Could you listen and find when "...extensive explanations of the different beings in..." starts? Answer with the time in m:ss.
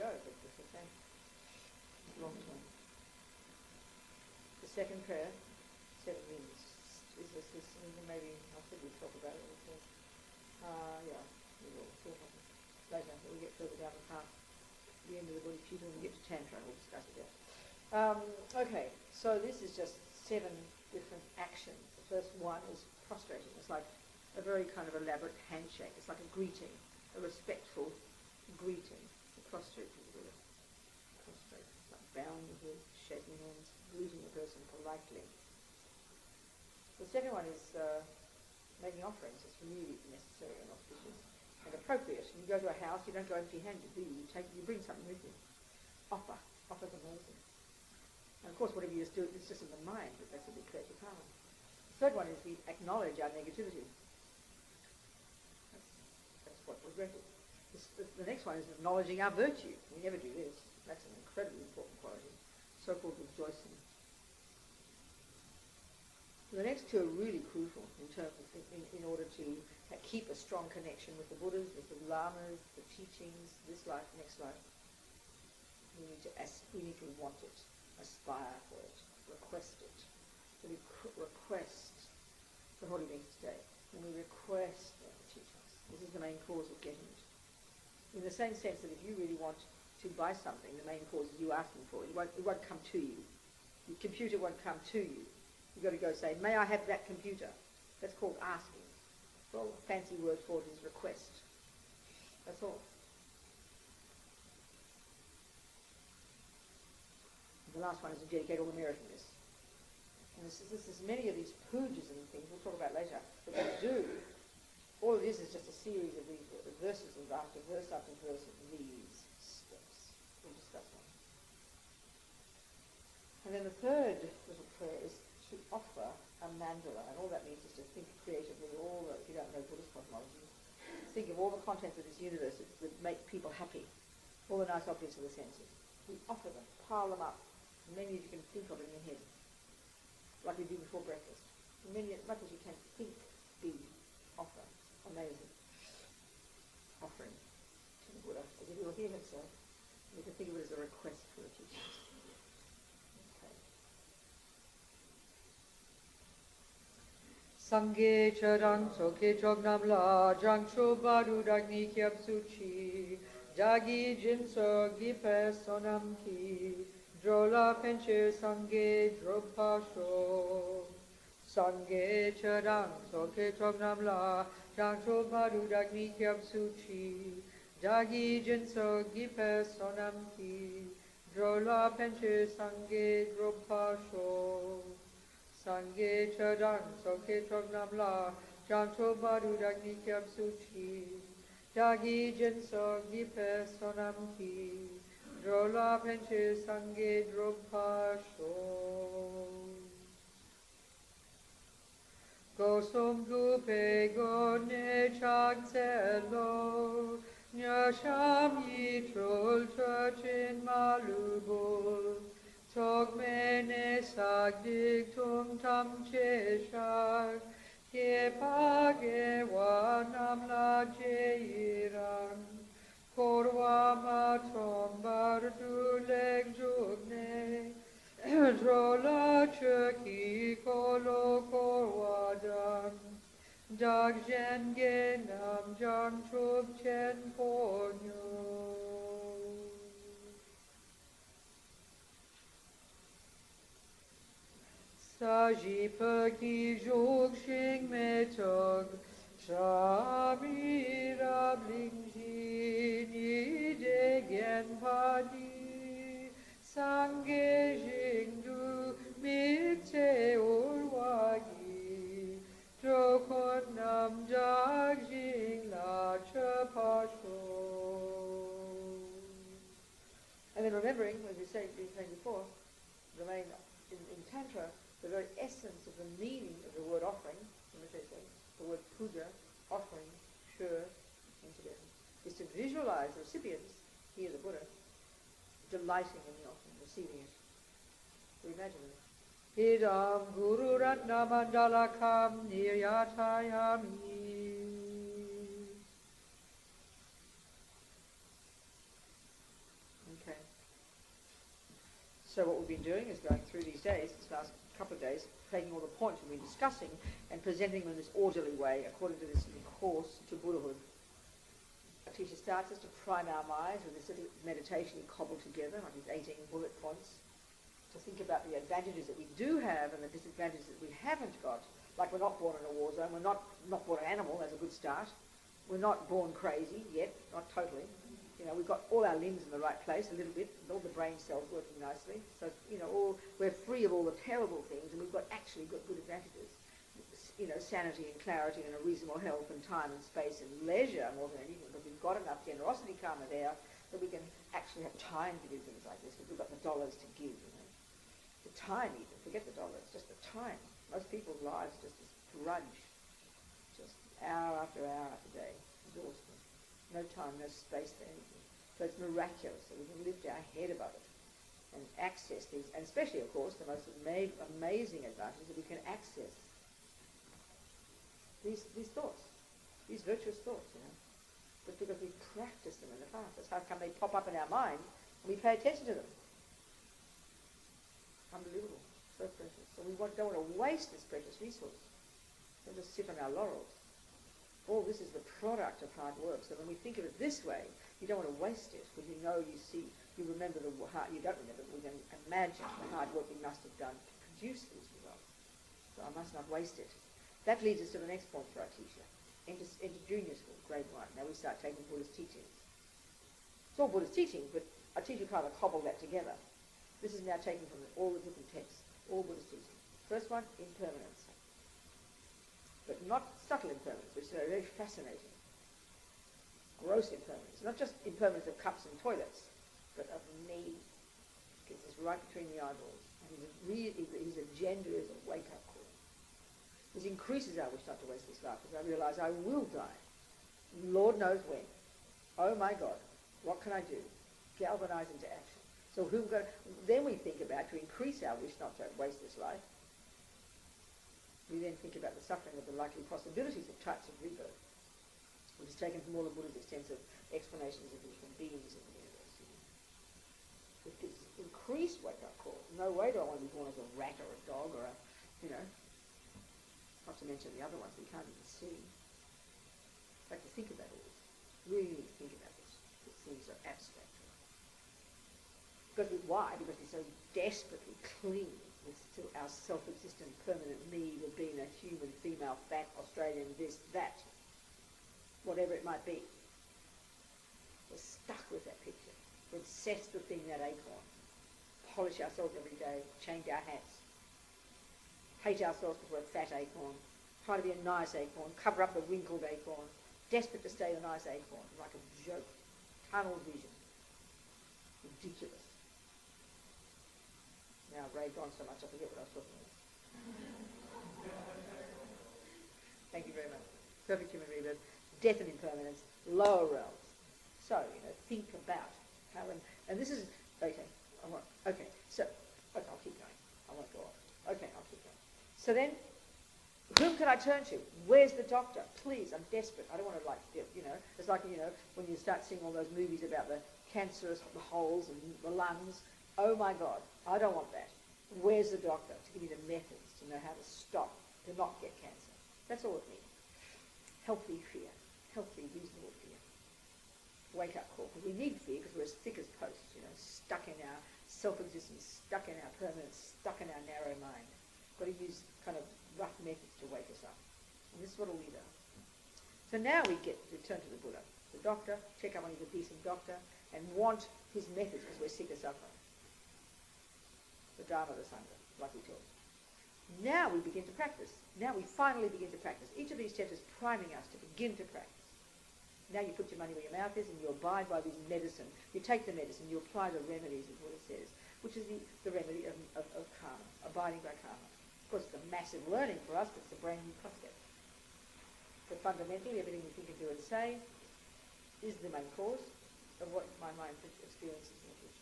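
7:26.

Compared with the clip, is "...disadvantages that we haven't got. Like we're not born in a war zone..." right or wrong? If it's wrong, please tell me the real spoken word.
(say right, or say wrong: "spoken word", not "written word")
right.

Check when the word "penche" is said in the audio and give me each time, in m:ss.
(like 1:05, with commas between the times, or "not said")
2:47, 3:01, 3:16.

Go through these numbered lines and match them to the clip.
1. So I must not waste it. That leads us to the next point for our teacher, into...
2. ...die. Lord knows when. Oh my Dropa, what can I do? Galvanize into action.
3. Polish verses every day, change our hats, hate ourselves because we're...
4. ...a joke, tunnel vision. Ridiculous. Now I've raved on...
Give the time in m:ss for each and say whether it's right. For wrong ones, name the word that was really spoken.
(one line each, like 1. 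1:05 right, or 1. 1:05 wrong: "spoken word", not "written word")
1. 6:35 right
2. 7:09 wrong: "God", not "Dropa"
3. 8:01 wrong: "ourselves", not "verses"
4. 8:11 right.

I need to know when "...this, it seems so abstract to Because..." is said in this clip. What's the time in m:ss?
7:42.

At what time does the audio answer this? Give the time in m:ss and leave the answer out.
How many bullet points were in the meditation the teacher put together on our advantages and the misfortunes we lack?
5:16.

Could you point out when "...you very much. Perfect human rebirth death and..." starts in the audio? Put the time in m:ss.
8:23.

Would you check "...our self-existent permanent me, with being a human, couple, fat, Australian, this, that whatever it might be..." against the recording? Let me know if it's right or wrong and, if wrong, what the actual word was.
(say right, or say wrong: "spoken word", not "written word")
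wrong: "female", not "couple".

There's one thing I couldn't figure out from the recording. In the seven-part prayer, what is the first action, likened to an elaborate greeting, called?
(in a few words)
prostrating.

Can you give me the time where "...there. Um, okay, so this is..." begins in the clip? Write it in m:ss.
0:17.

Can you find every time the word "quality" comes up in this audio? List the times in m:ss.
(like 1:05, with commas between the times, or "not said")
1:02.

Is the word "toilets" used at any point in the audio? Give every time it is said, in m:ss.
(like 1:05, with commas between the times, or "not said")
6:59.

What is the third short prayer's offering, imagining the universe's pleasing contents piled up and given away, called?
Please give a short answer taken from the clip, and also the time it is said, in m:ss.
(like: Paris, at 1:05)
a mandala, at 2:06.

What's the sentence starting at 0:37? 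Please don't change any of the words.
The second one is uh, making offerings.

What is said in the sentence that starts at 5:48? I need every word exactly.
The time even, forget the dollars, just the time.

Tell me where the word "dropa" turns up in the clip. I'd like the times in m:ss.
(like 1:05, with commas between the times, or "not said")
2:49, 3:03, 3:17.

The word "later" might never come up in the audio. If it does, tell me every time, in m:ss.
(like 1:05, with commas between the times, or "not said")
0:12, 1:52.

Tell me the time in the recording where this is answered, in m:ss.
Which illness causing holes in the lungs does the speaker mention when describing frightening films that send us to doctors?
8:43.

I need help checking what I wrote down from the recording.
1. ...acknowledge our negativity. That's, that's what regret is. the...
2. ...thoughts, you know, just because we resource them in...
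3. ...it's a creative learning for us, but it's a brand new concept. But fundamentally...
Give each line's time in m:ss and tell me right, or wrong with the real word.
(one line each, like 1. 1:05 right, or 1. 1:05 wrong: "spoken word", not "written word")
1. 0:52 right
2. 6:10 wrong: "practice", not "resource"
3. 9:35 wrong: "massive", not "creative".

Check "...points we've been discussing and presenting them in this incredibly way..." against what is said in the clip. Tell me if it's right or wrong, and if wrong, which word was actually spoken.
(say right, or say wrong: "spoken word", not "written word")
wrong: "orderly", not "incredibly".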